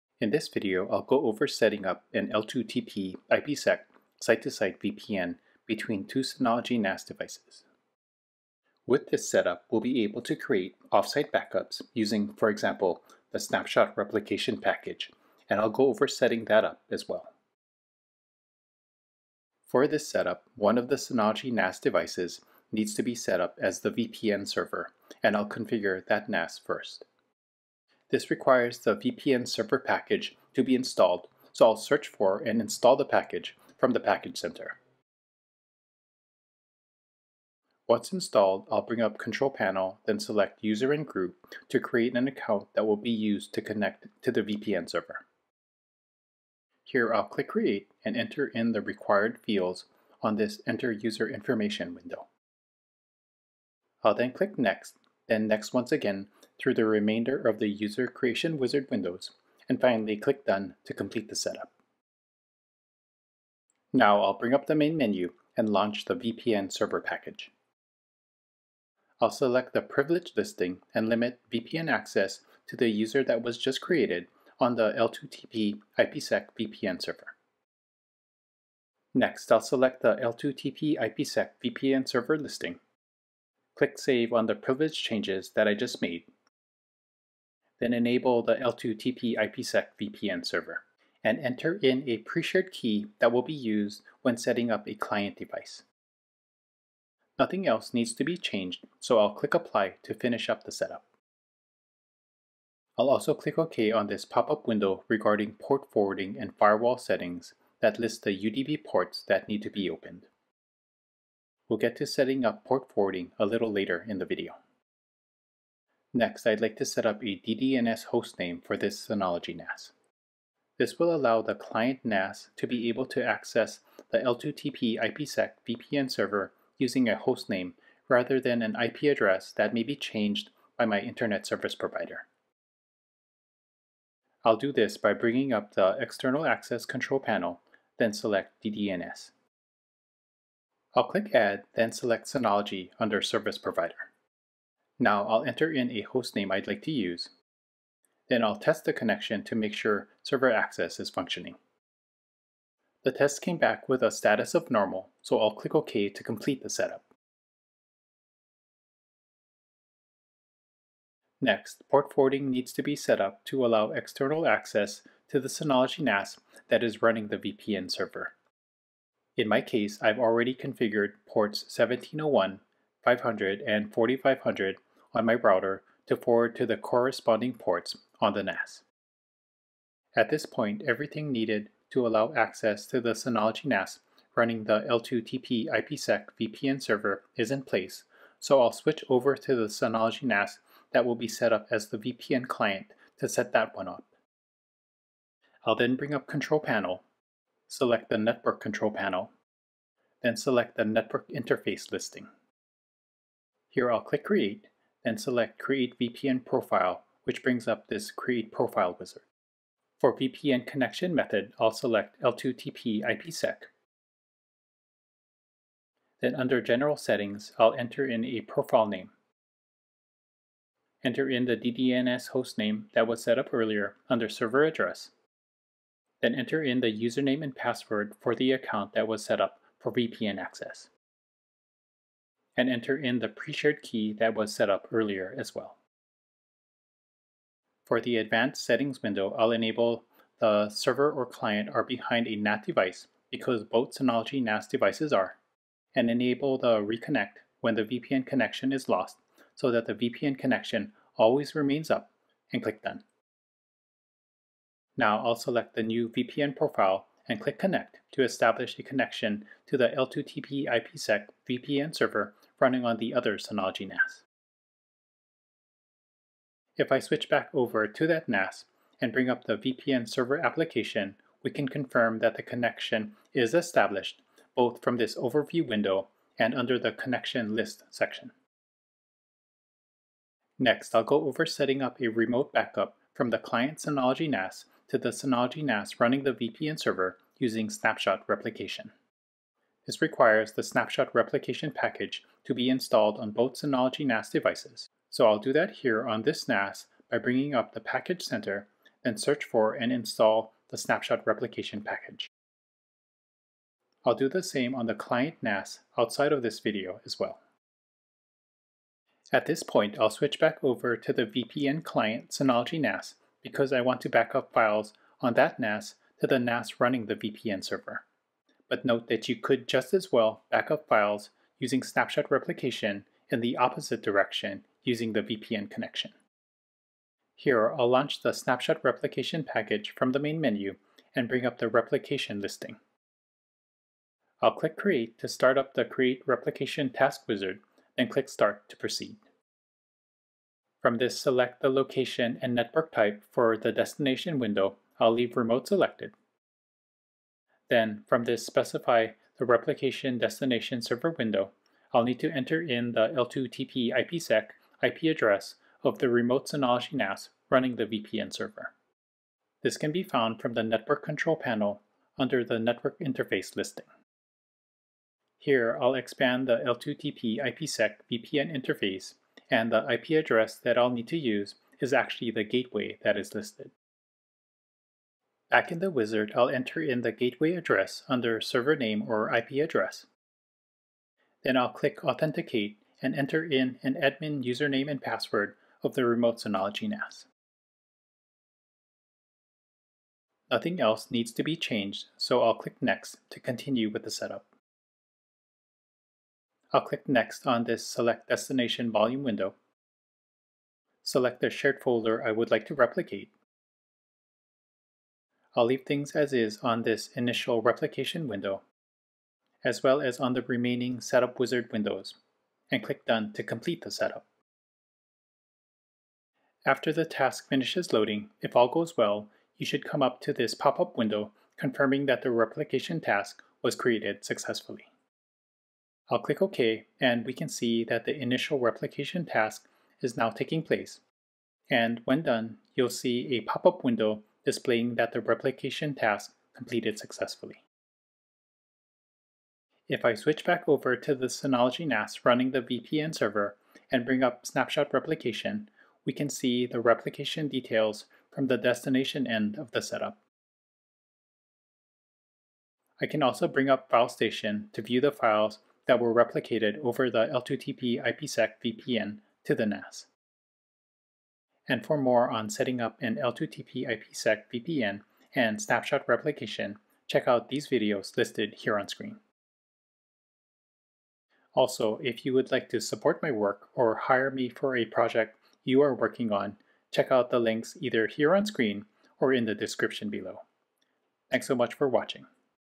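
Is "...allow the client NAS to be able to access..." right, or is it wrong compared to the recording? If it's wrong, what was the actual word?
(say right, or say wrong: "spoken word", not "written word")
right.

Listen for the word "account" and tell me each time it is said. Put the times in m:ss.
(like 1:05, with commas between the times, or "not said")
0:42, 3:48.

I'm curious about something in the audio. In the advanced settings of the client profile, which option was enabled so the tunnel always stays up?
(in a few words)
reconnect when the VPN connection is lost.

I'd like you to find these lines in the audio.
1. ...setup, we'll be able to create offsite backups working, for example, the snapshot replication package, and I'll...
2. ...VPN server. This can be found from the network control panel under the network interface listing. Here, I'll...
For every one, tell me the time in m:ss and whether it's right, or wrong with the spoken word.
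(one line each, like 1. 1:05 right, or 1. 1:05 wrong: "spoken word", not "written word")
1. 0:09 wrong: "using", not "working"
2. 5:57 right.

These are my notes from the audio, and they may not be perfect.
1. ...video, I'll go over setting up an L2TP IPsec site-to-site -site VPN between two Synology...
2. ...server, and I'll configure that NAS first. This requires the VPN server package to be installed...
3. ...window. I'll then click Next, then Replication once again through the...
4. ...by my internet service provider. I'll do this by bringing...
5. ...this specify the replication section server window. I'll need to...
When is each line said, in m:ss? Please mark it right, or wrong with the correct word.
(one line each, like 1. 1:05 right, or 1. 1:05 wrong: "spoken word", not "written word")
1. 0:00 right
2. 0:24 right
3. 0:51 wrong: "Next", not "Replication"
4. 2:10 right
5. 5:48 wrong: "destination", not "section".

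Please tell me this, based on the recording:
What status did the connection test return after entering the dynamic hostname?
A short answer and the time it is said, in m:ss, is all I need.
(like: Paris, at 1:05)
normal, at 2:34.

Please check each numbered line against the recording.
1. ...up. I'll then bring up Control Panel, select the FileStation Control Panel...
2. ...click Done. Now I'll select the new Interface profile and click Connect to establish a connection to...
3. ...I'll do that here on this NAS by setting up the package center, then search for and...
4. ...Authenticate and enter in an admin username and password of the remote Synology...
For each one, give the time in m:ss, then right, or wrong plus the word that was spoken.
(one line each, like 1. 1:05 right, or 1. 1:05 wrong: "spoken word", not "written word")
1. 3:13 wrong: "Network", not "FileStation"
2. 4:12 wrong: "VPN", not "Interface"
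3. 4:55 wrong: "bringing", not "setting"
4. 6:22 right.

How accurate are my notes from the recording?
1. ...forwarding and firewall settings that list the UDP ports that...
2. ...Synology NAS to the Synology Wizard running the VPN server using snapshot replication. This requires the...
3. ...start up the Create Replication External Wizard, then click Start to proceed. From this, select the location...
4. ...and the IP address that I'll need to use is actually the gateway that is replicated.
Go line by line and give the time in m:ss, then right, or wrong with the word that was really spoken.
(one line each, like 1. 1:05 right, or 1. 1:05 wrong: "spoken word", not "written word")
1. 1:45 right
2. 4:43 wrong: "NAS", not "Wizard"
3. 5:35 wrong: "Task", not "External"
4. 6:09 wrong: "listed", not "replicated".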